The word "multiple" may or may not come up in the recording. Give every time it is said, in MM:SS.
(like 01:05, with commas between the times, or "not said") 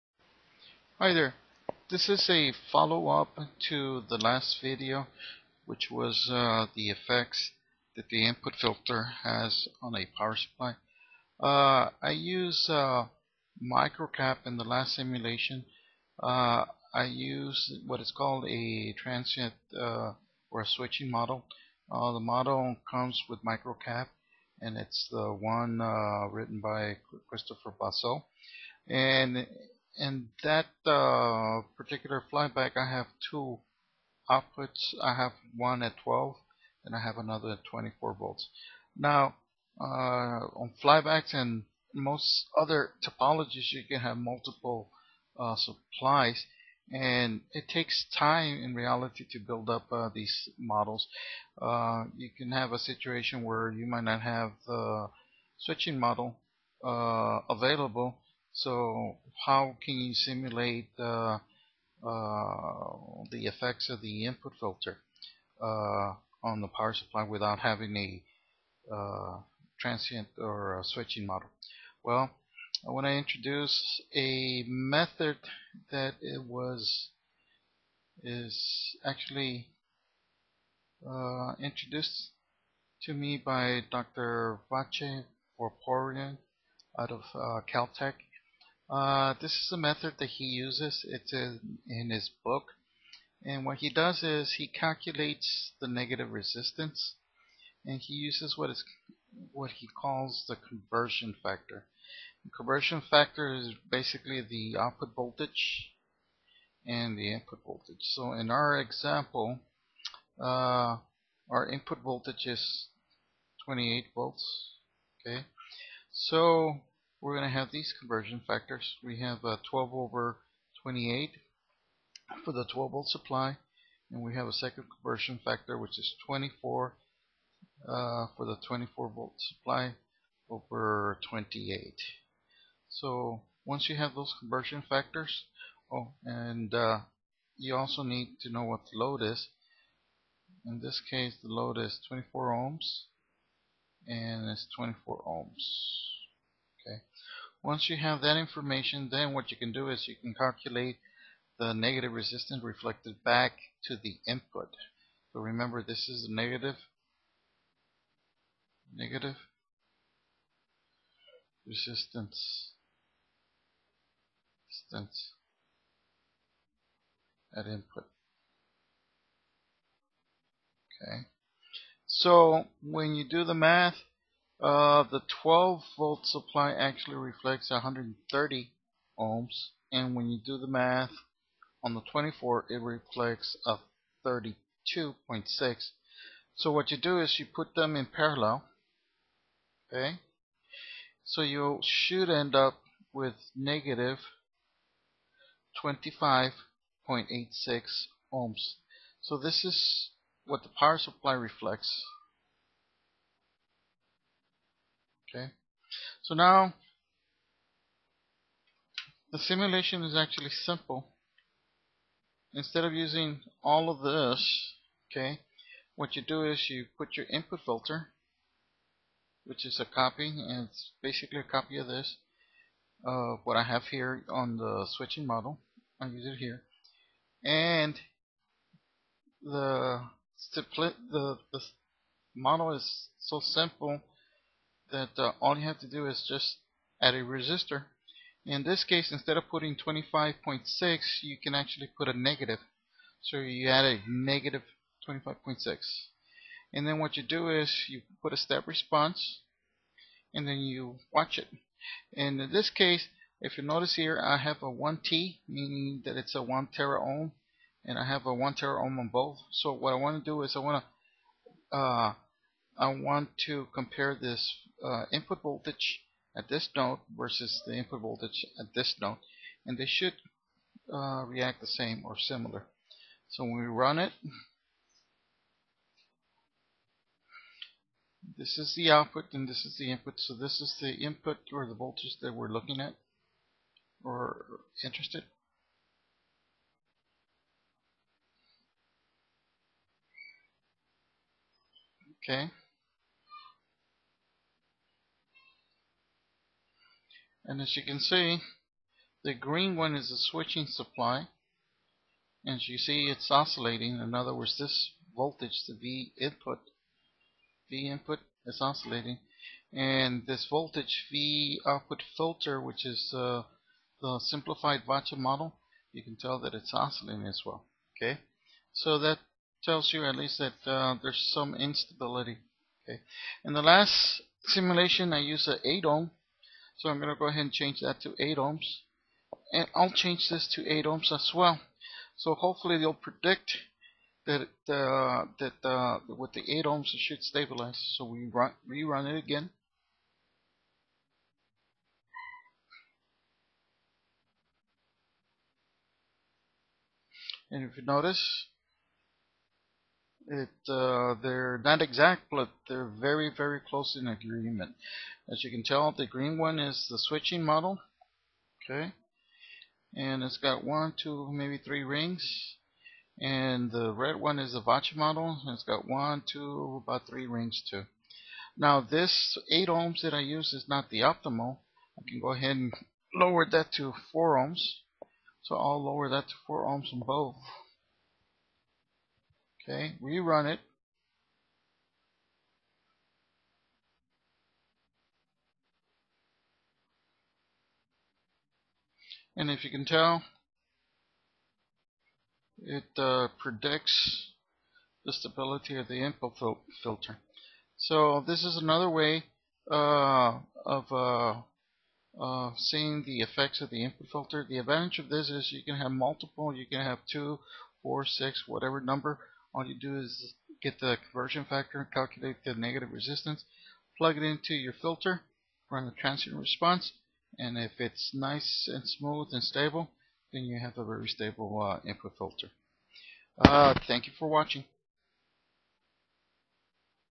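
00:44, 06:45.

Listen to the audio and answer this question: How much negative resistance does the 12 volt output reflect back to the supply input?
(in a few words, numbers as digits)
130 ohms.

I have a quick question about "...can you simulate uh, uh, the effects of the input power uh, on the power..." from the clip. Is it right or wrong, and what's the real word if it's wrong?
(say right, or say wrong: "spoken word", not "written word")
wrong: "filter", not "power".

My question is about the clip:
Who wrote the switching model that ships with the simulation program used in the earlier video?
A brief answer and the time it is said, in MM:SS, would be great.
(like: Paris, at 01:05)
Christopher Basso, at 00:27.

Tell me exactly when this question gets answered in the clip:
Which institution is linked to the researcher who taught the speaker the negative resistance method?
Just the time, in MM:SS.
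01:27.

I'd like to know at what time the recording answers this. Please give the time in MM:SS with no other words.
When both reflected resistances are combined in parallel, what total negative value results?
03:13.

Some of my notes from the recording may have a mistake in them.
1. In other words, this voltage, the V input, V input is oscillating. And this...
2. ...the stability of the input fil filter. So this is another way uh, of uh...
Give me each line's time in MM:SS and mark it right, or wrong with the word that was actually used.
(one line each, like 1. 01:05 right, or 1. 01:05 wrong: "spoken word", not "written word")
1. 05:03 right
2. 06:35 right.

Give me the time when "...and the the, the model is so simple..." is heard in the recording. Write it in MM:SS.
03:47.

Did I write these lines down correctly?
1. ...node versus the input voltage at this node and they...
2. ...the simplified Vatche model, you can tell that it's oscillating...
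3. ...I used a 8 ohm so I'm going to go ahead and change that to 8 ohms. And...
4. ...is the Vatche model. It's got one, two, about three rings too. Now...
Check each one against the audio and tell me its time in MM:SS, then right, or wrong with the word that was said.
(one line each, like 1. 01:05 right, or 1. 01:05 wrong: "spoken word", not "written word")
1. 04:26 right
2. 05:14 right
3. 05:25 right
4. 06:04 right.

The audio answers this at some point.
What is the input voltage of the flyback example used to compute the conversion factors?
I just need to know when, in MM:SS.
01:53.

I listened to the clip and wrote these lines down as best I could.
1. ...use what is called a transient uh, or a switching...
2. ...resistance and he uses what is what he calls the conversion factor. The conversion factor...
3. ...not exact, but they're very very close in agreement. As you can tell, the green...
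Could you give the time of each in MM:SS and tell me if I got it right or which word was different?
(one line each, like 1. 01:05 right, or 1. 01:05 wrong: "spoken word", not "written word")
1. 00:17 right
2. 01:36 right
3. 05:51 right.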